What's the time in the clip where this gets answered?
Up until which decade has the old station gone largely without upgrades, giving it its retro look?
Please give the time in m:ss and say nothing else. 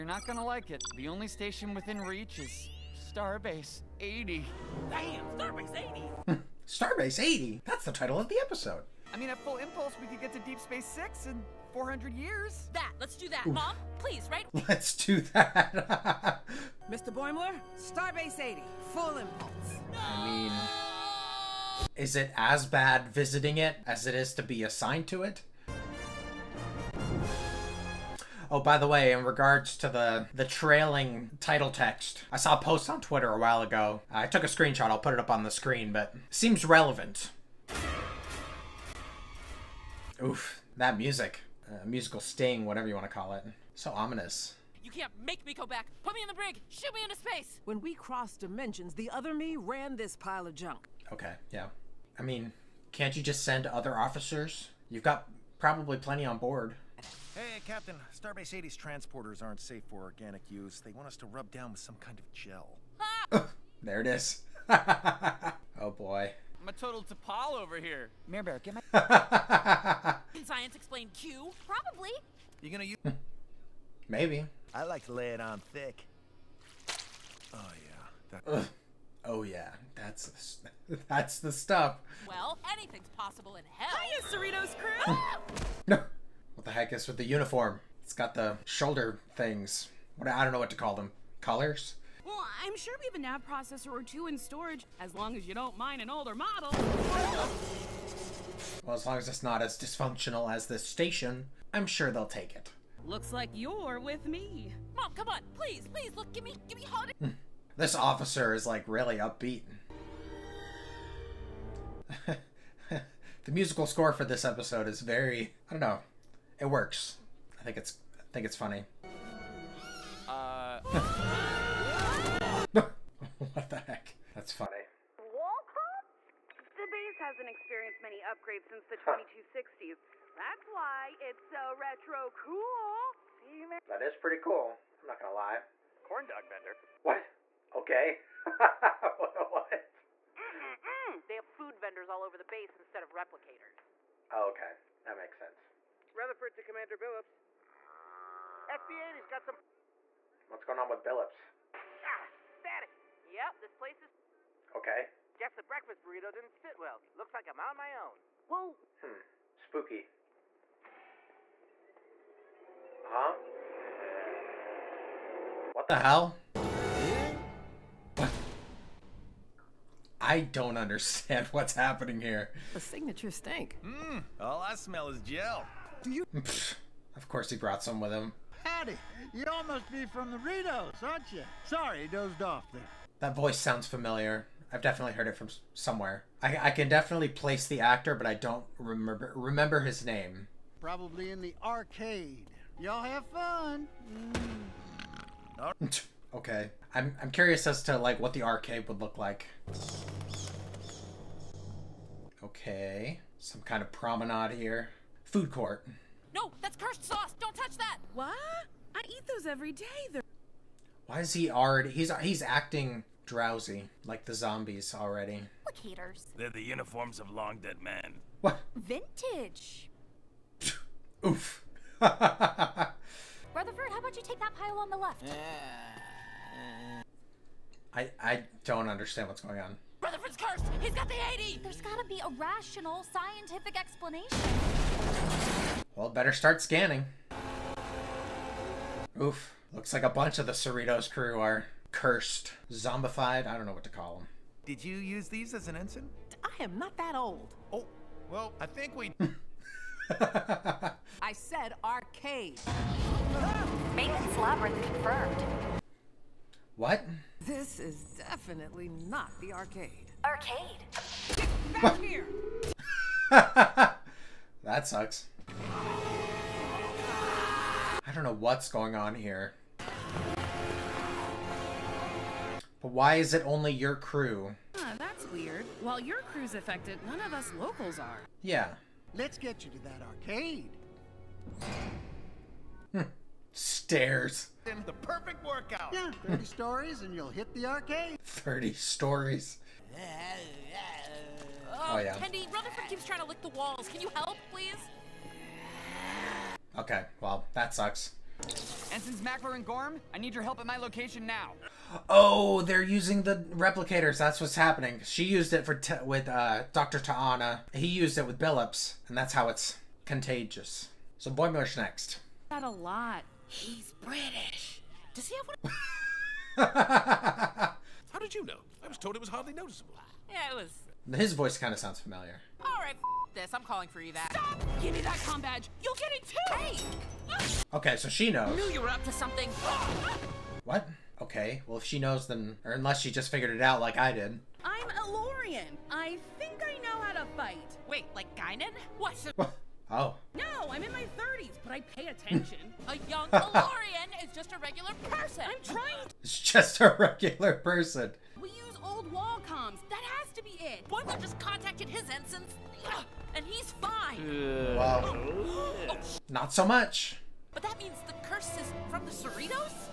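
2:09.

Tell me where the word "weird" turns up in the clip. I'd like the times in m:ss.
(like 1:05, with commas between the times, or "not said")
4:35.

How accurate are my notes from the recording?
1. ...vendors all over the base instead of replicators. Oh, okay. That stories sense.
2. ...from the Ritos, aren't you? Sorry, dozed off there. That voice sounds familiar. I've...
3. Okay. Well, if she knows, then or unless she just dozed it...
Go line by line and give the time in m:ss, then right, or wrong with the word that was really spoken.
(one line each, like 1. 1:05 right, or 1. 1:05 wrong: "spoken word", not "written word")
1. 2:21 wrong: "makes", not "stories"
2. 3:00 right
3. 5:31 wrong: "figured", not "dozed".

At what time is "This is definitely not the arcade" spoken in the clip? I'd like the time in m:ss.
4:17.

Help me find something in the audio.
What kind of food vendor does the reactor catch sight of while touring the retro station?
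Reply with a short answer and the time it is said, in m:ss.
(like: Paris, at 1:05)
Corn dog, at 2:16.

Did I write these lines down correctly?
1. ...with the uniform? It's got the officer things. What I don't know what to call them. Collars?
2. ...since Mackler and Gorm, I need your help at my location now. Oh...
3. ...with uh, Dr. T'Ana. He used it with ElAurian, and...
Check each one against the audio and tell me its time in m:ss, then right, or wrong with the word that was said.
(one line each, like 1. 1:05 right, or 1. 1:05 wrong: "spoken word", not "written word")
1. 1:27 wrong: "shoulder", not "officer"
2. 4:59 right
3. 5:06 wrong: "Billups", not "ElAurian".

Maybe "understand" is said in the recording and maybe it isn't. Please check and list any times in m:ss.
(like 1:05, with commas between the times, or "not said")
2:50, 3:48.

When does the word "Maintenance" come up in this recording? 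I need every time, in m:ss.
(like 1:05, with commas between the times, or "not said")
4:13.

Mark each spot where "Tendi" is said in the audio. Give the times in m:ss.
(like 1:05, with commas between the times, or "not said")
4:52.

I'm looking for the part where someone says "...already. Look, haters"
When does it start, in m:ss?
3:34.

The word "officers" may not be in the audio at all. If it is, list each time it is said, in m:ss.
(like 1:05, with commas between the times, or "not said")
0:53, 1:47.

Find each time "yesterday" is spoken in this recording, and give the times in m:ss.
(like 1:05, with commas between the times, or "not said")
not said.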